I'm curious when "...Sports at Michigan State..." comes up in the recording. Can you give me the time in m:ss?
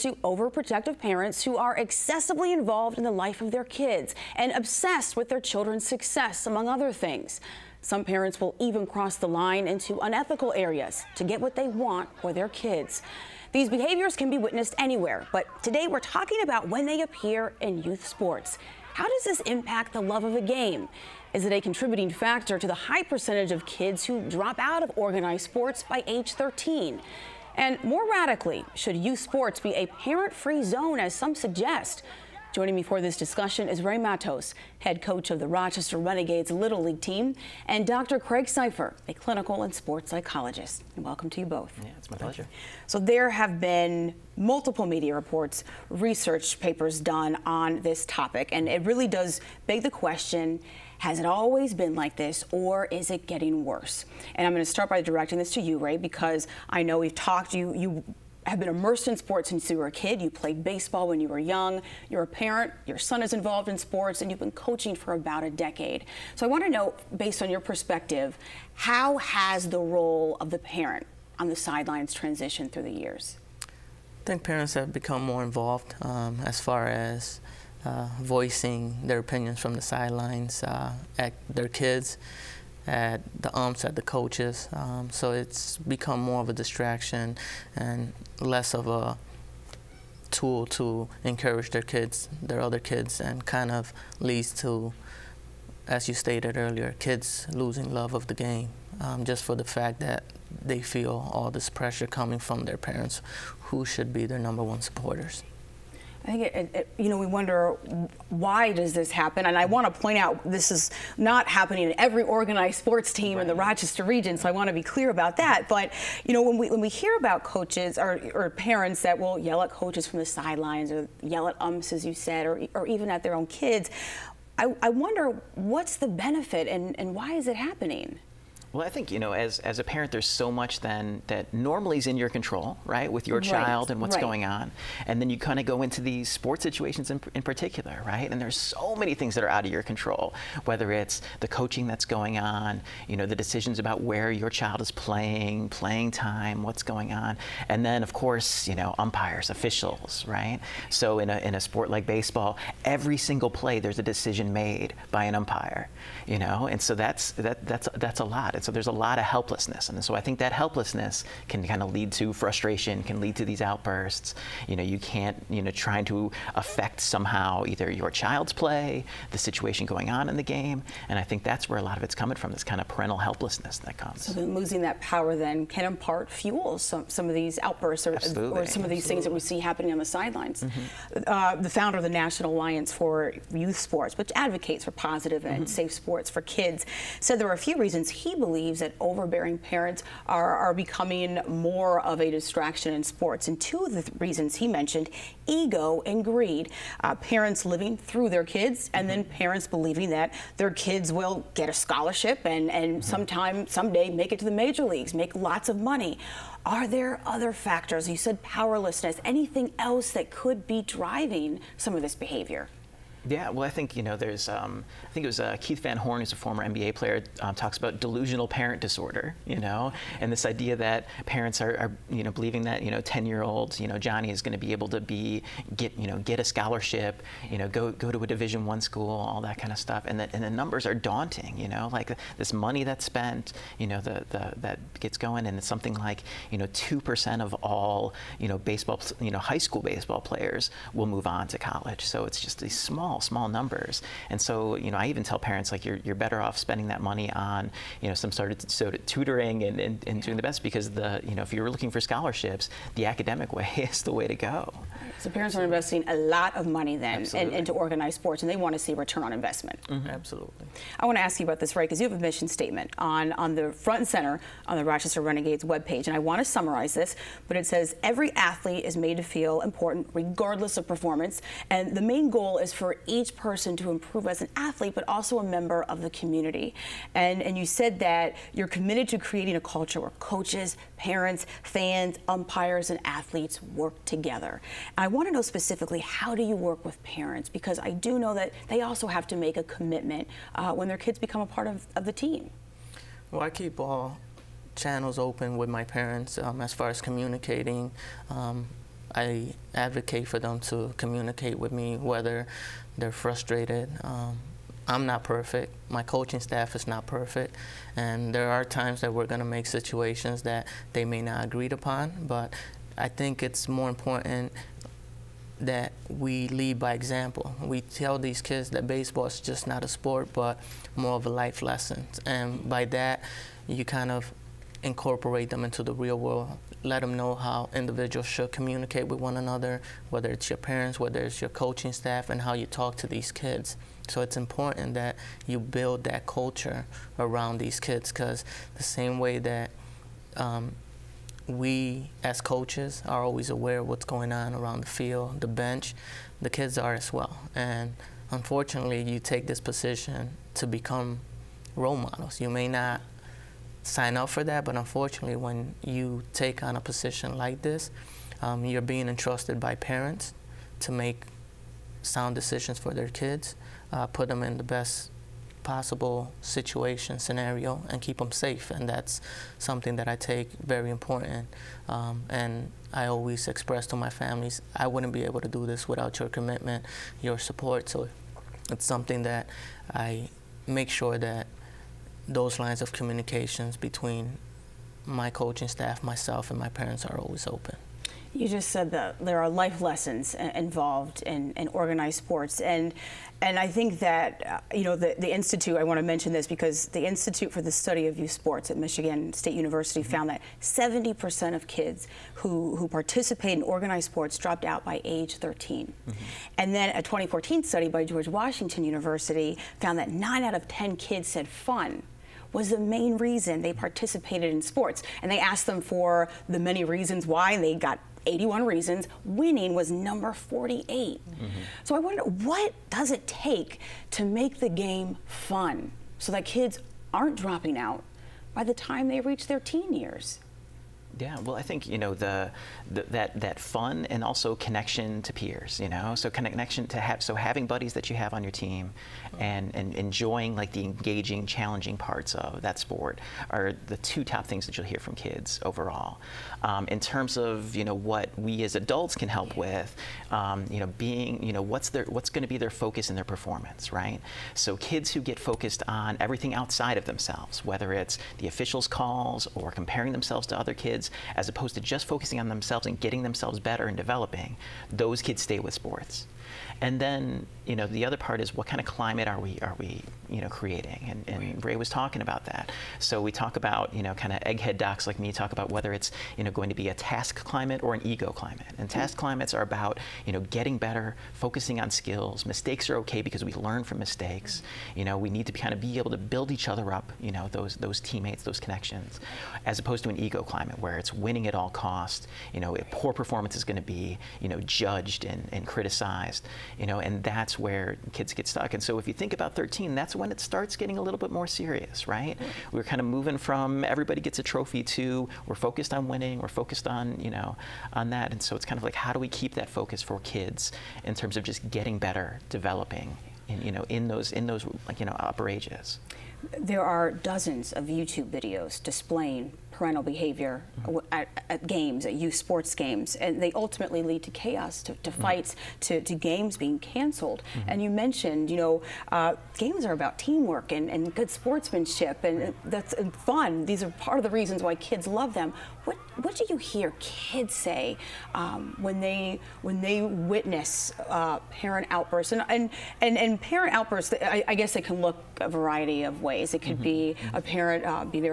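6:38.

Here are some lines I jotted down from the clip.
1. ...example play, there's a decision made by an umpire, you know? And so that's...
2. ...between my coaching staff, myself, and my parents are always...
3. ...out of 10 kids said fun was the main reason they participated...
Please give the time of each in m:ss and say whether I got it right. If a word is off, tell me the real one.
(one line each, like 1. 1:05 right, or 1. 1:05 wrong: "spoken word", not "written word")
1. 2:33 wrong: "single", not "example"
2. 6:23 right
3. 6:50 right.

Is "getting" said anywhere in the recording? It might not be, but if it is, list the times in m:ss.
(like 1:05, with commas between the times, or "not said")
0:53, 7:42, 8:00, 8:20, 8:31.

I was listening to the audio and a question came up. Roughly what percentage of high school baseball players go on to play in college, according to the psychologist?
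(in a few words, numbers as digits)
2 percent.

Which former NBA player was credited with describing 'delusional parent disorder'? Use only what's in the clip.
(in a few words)
Keith Van Horn.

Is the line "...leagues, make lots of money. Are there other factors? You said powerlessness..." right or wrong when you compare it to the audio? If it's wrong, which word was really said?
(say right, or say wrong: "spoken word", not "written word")
right.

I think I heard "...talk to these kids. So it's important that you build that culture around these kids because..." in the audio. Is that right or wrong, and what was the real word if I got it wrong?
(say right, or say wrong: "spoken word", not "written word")
right.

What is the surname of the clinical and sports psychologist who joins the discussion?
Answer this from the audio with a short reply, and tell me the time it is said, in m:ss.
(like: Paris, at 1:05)
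Seifer, at 0:38.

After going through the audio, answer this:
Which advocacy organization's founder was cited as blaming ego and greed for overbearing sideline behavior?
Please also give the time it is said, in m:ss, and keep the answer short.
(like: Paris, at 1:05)
National Alliance for Youth Sports, at 3:02.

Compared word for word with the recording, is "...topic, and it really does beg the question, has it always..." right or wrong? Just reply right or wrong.
right.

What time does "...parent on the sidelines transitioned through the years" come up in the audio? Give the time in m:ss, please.
1:10.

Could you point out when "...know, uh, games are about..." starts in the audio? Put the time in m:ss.
8:48.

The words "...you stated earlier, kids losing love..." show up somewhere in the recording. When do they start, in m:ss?
1:36.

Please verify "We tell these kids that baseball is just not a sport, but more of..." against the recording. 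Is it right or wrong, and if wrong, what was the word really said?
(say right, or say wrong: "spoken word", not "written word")
right.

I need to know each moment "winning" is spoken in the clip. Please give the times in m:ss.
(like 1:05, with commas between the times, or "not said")
6:59, 8:11, 8:26.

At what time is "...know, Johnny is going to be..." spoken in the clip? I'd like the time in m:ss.
3:43.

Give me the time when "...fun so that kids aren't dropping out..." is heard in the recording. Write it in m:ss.
7:05.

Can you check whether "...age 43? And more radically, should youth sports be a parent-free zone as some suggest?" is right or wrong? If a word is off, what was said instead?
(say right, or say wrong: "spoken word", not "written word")
wrong: "13", not "43".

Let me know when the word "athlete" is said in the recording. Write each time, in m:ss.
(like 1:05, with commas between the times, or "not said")
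4:28, 4:34, 4:43.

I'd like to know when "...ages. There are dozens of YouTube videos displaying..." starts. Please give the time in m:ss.
8:35.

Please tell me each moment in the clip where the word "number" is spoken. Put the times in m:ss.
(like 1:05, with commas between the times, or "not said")
1:44, 3:50, 4:03, 6:59.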